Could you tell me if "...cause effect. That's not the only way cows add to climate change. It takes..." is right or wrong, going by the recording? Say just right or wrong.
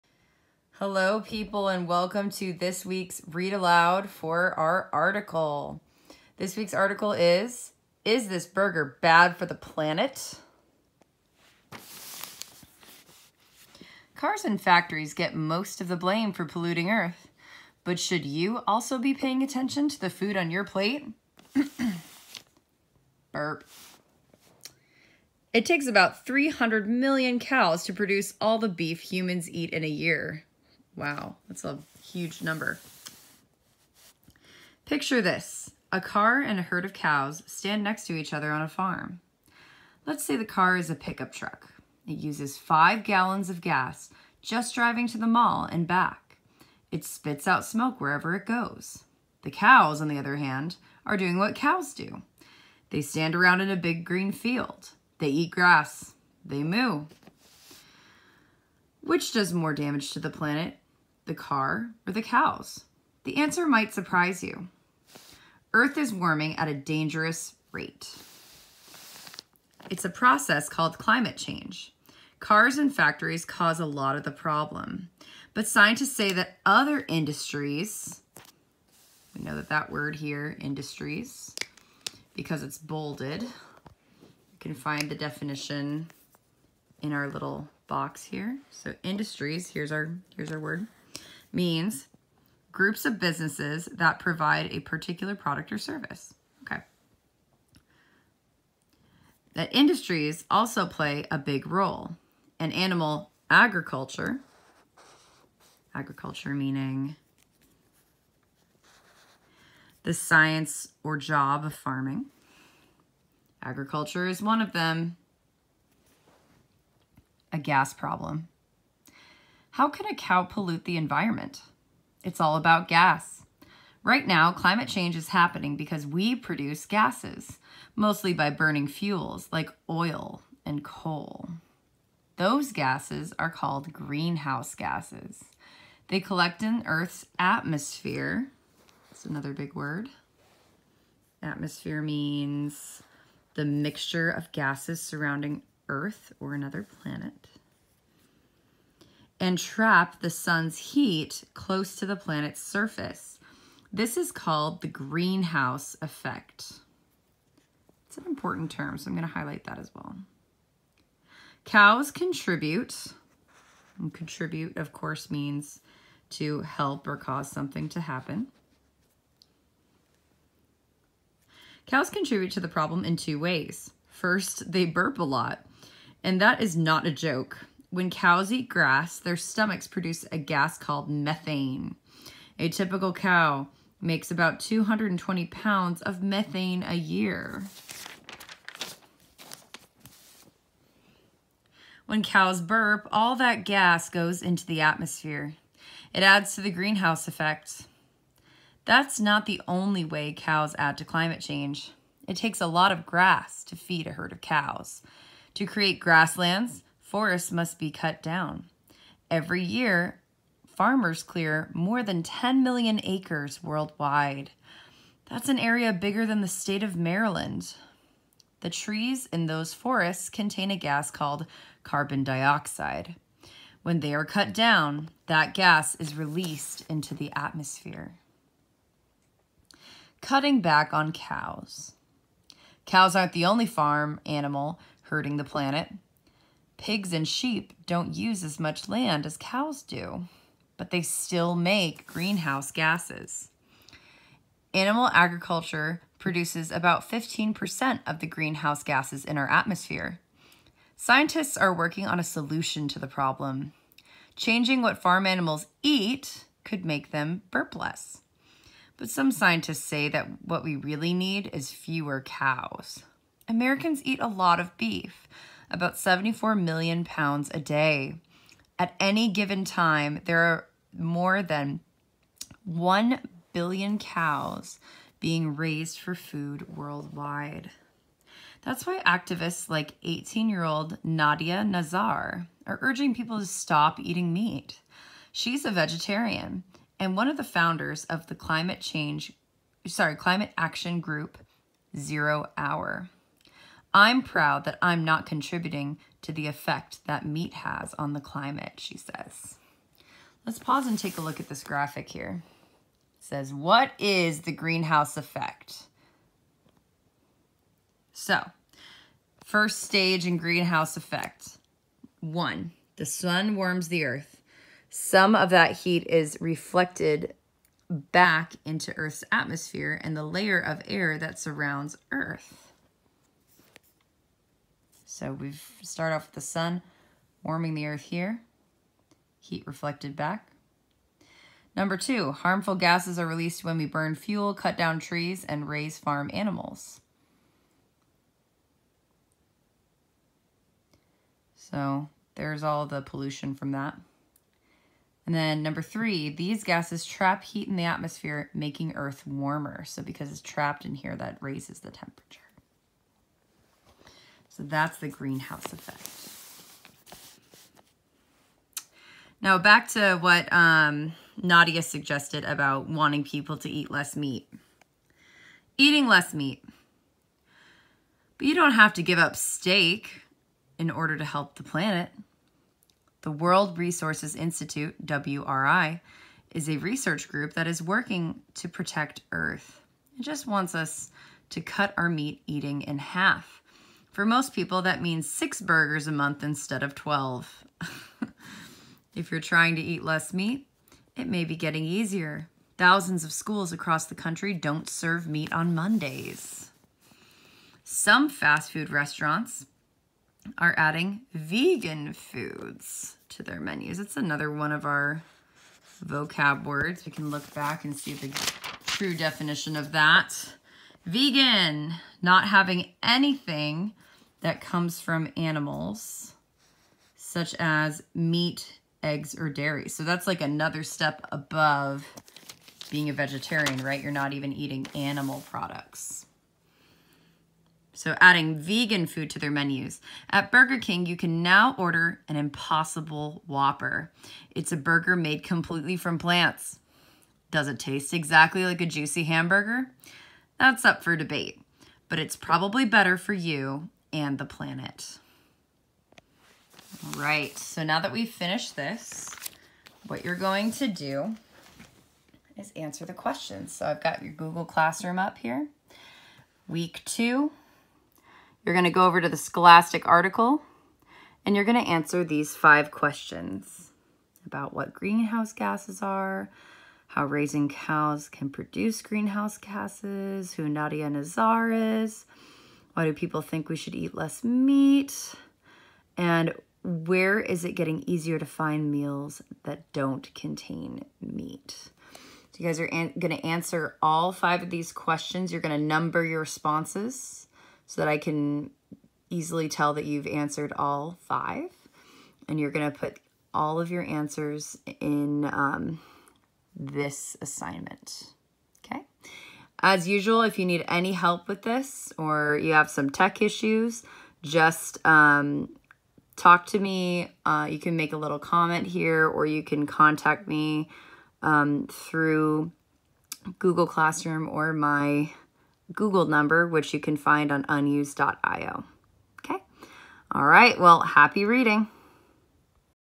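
wrong.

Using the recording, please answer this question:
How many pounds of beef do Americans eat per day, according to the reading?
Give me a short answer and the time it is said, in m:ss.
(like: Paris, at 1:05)
74 million, at 4:25.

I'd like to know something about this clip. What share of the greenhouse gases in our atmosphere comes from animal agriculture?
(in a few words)
15%.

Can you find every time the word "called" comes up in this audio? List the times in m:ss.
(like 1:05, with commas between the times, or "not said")
1:10, 2:13, 2:34, 3:00, 3:41.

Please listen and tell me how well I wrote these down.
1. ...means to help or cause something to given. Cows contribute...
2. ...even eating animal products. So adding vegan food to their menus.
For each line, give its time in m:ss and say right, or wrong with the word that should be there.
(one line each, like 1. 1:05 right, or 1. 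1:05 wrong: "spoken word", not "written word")
1. 2:45 wrong: "happen", not "given"
2. 7:04 right.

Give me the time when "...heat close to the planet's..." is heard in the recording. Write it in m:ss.
2:30.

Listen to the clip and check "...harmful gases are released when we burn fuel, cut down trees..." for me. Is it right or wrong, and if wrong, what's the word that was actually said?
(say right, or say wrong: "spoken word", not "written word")
right.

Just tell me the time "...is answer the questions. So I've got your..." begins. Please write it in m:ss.
7:32.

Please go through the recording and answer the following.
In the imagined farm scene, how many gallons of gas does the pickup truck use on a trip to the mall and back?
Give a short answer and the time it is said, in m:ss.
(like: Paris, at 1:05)
5, at 0:42.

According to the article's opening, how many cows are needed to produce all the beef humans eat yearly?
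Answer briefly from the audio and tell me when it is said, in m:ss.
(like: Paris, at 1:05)
300 million, at 0:26.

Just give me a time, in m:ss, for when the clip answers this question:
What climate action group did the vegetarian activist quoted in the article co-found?
4:51.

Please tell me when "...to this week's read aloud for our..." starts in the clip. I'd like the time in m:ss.
0:02.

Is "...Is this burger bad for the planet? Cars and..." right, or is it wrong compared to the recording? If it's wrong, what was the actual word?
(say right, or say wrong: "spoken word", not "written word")
right.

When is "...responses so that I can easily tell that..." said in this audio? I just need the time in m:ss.
8:06.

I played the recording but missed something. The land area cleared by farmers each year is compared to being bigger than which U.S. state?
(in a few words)
Maryland.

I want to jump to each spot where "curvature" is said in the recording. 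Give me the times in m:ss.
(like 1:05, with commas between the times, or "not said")
not said.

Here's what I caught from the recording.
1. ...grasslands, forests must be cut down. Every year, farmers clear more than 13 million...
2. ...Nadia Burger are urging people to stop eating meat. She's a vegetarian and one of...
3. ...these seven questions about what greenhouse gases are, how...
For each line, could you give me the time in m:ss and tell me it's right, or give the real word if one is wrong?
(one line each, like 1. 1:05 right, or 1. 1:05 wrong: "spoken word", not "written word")
1. 3:25 wrong: "10", not "13"
2. 4:41 wrong: "Nazar", not "Burger"
3. 7:42 wrong: "five", not "seven".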